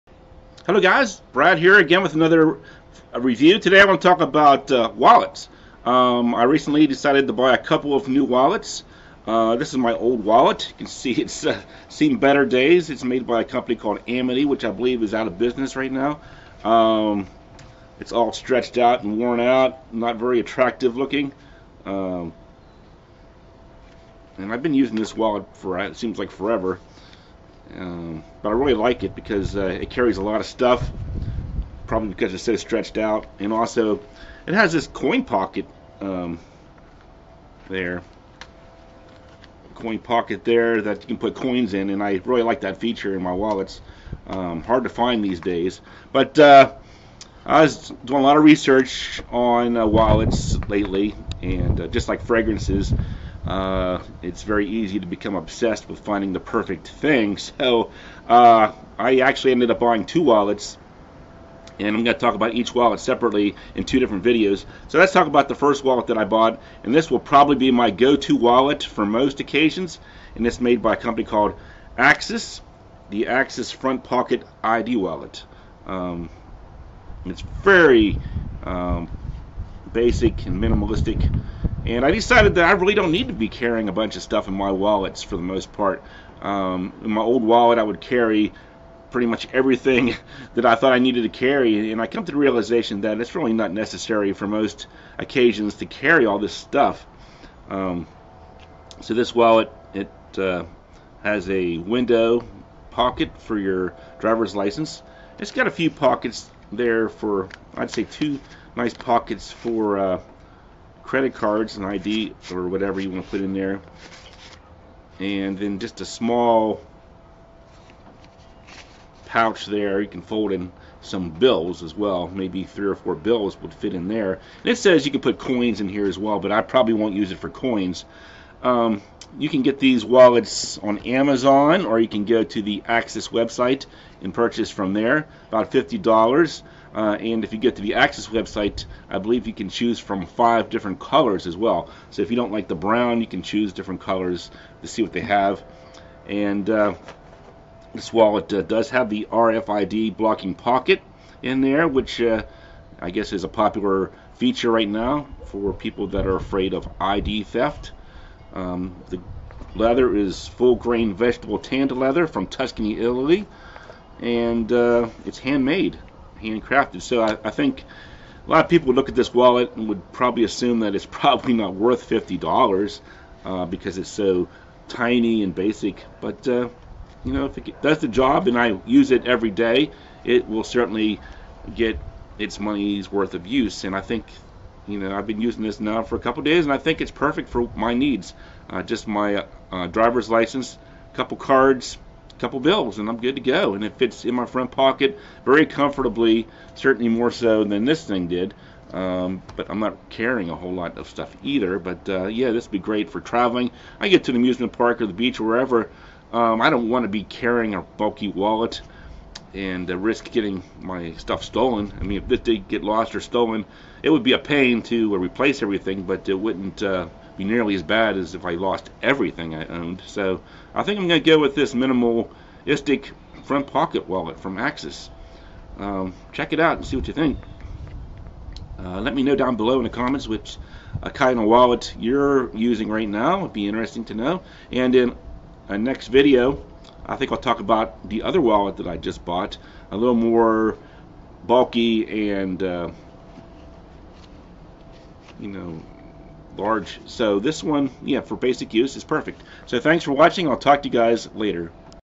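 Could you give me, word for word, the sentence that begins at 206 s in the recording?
Um, I don't want to be carrying a bulky wallet and uh, risk getting my stuff stolen.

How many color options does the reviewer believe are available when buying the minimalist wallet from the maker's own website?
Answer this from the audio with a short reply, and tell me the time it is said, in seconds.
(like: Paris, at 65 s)
5, at 140 s.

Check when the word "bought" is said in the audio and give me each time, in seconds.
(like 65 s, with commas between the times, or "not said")
66 s, 239 s.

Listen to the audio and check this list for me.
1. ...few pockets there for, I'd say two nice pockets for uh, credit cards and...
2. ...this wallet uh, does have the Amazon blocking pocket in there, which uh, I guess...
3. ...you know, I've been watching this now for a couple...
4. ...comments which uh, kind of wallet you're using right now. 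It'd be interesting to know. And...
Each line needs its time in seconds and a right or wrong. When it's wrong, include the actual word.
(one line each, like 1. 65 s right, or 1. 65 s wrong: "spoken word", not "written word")
1. 105 s right
2. 147 s wrong: "RFID", not "Amazon"
3. 184 s wrong: "using", not "watching"
4. 229 s right.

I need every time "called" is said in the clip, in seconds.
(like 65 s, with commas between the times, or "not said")
13 s, 71 s.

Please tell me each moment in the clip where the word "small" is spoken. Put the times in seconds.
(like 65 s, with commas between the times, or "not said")
116 s.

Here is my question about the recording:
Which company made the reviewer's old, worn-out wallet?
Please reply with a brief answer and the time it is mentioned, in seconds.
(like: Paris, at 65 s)
Amity, at 14 s.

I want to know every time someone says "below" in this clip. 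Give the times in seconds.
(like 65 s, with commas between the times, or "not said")
229 s.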